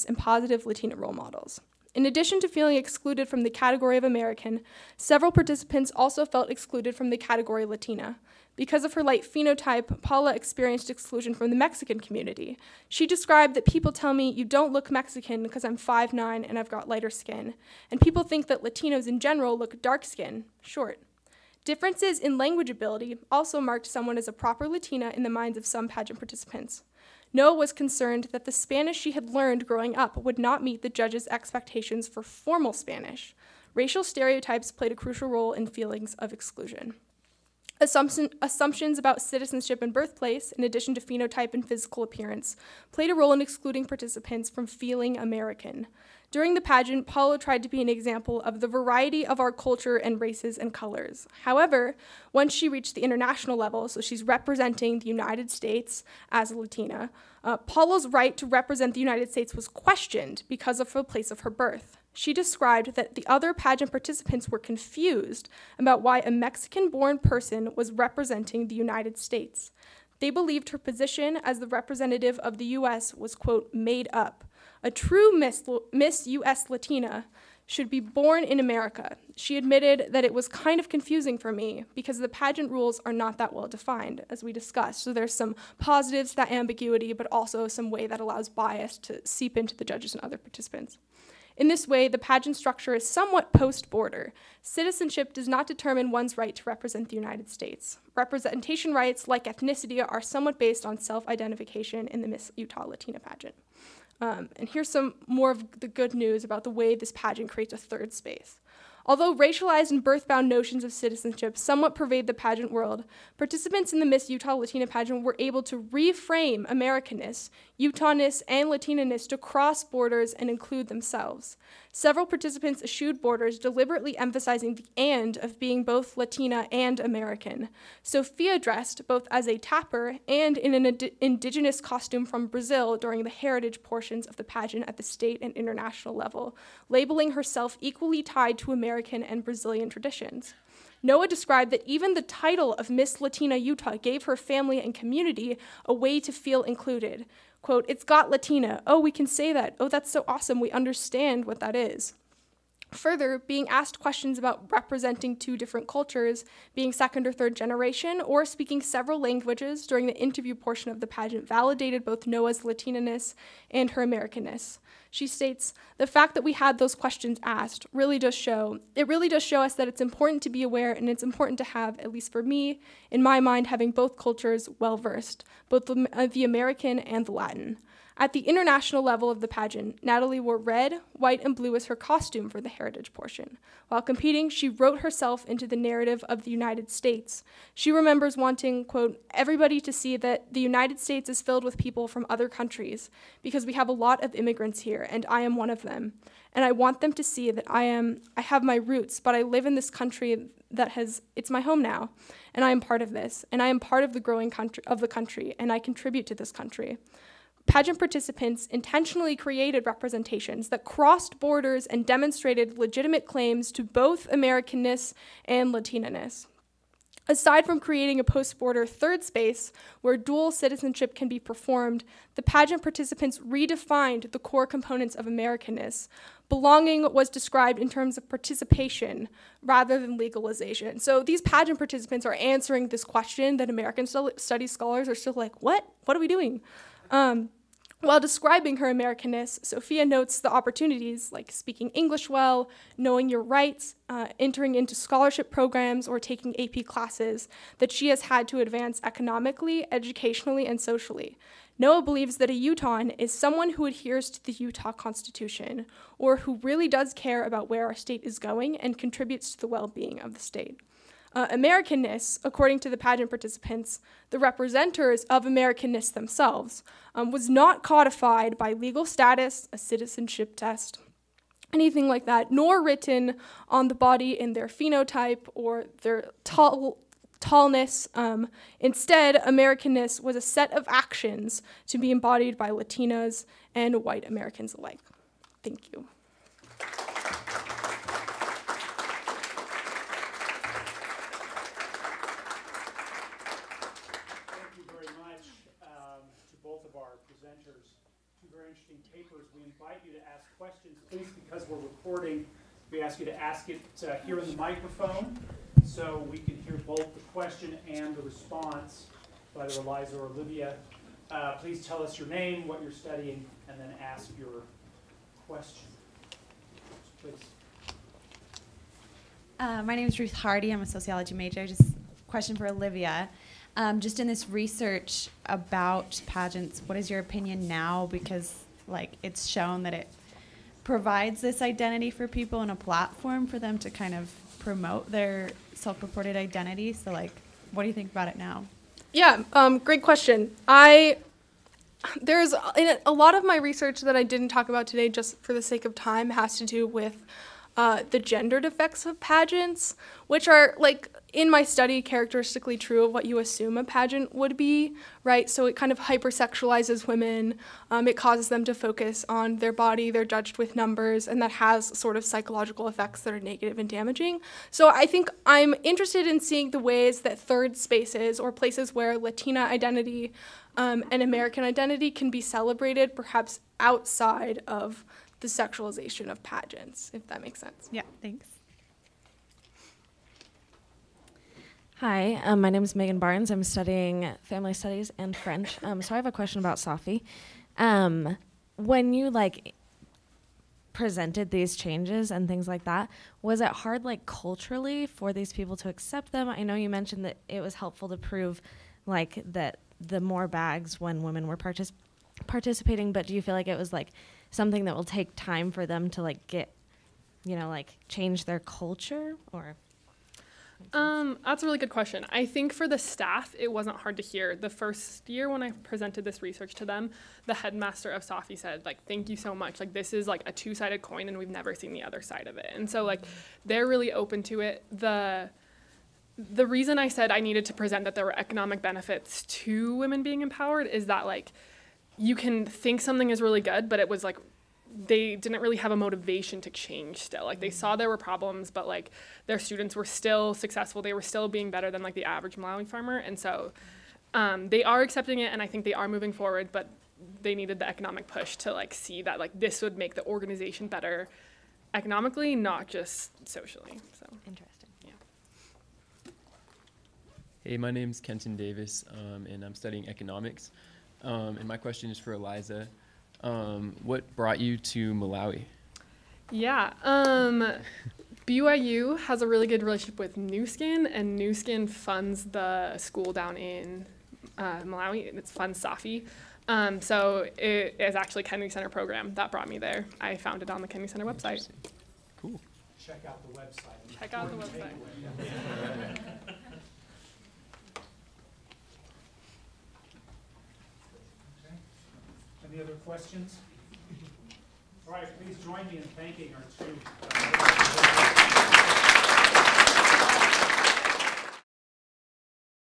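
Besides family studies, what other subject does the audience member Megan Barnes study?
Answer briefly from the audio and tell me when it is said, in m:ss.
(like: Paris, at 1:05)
French, at 6:25.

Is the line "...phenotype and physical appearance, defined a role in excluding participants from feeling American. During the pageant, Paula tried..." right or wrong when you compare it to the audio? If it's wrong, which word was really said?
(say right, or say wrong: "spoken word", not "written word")
wrong: "played", not "defined".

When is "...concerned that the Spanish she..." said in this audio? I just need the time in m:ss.
0:27.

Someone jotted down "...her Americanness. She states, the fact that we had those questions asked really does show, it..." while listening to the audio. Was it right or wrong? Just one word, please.
right.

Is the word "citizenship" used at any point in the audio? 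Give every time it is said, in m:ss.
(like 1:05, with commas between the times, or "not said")
0:39, 1:34, 1:50, 3:40, 4:29.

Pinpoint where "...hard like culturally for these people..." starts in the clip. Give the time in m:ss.
6:33.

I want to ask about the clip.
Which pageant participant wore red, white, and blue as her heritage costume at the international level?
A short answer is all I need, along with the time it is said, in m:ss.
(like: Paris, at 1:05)
Natalie, at 3:00.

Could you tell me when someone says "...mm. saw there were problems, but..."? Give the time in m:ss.
7:17.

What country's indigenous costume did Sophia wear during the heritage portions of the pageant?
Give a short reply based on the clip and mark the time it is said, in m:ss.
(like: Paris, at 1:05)
Brazil, at 2:12.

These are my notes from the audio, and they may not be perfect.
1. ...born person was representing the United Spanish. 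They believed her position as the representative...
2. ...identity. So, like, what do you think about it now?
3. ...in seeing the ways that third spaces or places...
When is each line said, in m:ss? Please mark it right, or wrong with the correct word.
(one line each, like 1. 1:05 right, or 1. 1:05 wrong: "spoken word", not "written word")
1. 1:06 wrong: "States", not "Spanish"
2. 5:36 right
3. 6:06 right.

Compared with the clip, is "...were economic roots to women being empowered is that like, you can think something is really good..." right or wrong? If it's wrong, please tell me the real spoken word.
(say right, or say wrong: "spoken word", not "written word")
wrong: "benefits", not "roots".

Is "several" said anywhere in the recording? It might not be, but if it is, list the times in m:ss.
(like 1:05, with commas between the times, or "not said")
0:04, 2:01, 2:38.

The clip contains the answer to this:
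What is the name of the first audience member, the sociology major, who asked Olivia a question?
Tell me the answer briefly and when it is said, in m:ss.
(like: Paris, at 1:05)
Ruth Hardy, at 5:20.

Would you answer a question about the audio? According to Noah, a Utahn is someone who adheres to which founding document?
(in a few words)
Utah Constitution.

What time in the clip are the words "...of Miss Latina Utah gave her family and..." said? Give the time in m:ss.
2:22.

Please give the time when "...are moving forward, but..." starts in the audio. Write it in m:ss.
7:25.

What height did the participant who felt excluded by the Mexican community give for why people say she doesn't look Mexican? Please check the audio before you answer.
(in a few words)
5'9.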